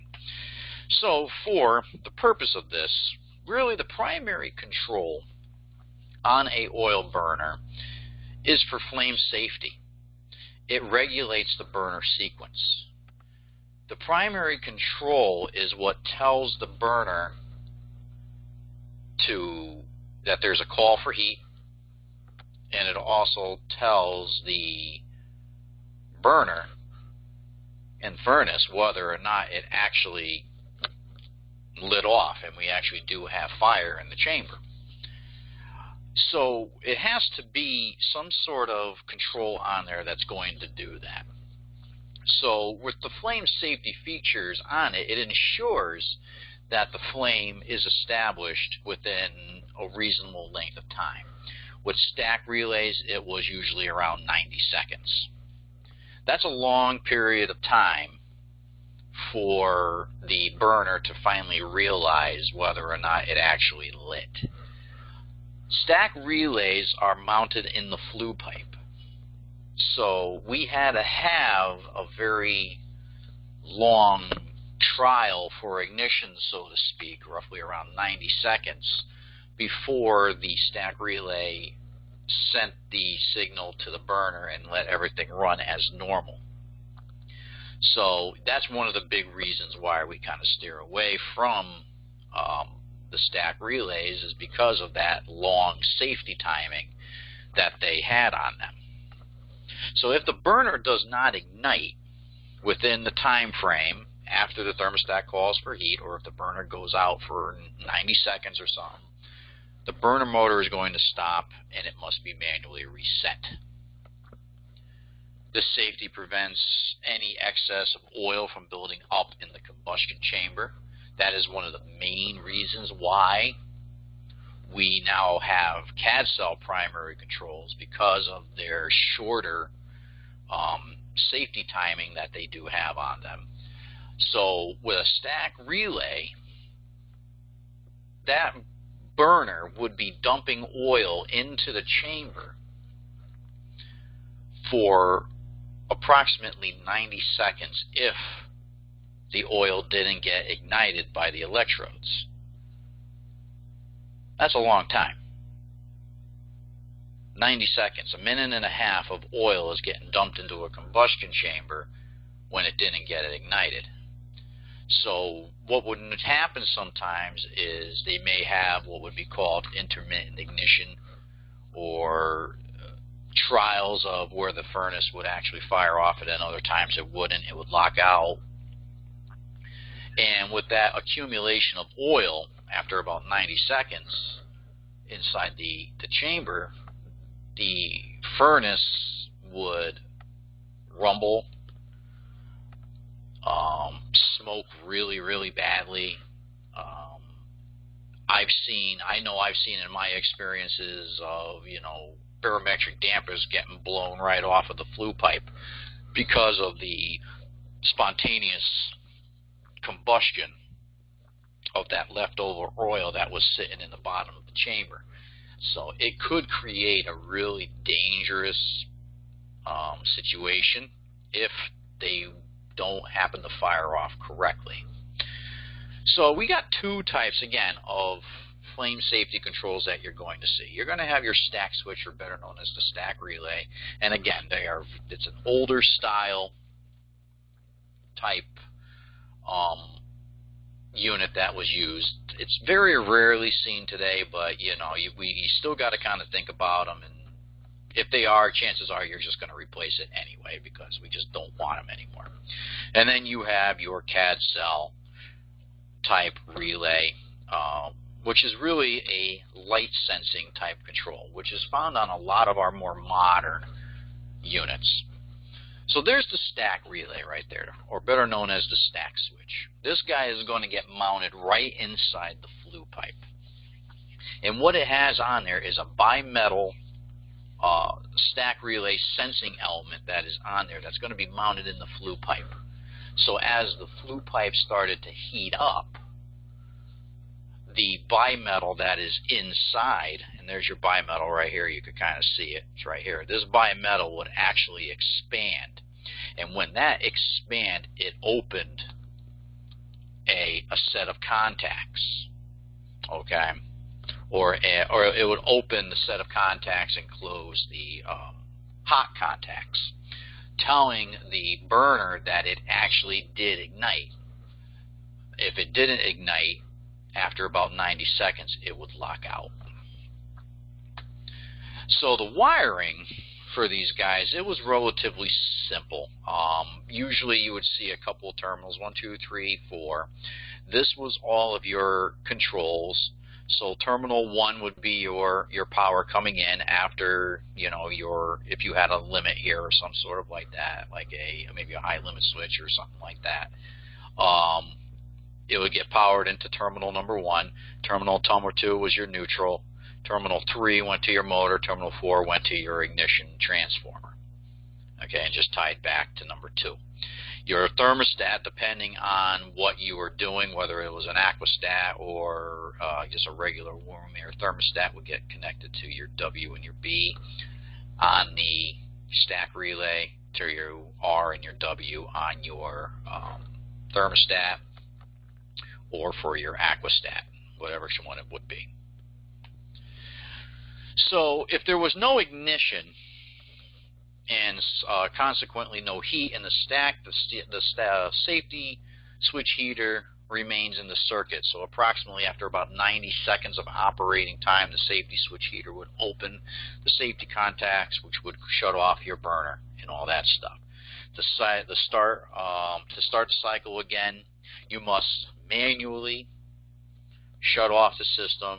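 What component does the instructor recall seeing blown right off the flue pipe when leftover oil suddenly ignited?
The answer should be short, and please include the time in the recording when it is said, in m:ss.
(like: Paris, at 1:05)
barometric dampers, at 3:22.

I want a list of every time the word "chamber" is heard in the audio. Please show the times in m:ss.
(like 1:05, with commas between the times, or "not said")
0:34, 2:00, 2:22, 2:41, 3:06, 3:34.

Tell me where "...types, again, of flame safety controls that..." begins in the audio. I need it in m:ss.
3:47.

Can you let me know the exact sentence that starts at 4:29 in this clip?
This guy is going to get mounted right inside the flue pipe.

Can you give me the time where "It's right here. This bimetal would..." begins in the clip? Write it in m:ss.
4:52.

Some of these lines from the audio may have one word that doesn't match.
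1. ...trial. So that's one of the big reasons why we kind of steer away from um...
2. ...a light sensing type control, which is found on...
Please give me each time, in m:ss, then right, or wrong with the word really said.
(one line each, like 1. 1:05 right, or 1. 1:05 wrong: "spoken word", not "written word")
1. 1:25 wrong: "normal", not "trial"
2. 4:19 right.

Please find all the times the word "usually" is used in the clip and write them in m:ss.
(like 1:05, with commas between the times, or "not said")
0:53, 5:26.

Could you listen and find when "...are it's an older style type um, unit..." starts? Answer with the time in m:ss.
3:54.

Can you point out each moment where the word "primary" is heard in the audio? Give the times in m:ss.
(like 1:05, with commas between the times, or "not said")
0:03, 0:13, 2:06.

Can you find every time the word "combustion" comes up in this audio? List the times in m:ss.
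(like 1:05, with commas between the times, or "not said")
1:59, 2:40, 3:29.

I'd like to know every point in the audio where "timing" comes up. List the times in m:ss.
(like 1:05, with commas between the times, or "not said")
1:36, 2:11.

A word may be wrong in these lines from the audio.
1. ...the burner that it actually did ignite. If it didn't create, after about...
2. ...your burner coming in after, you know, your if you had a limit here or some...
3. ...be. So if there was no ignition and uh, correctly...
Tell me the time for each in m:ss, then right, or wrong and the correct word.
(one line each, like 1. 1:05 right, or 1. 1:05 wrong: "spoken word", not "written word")
1. 5:11 wrong: "ignite", not "create"
2. 5:35 wrong: "power", not "burner"
3. 6:18 wrong: "consequently", not "correctly".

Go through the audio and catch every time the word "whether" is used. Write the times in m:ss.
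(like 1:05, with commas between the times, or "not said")
0:28, 1:02, 6:00.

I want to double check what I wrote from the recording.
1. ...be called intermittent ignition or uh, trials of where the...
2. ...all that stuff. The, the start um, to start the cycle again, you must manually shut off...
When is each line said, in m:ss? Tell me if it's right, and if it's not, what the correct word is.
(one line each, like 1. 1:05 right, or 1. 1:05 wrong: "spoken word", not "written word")
1. 2:49 right
2. 6:39 right.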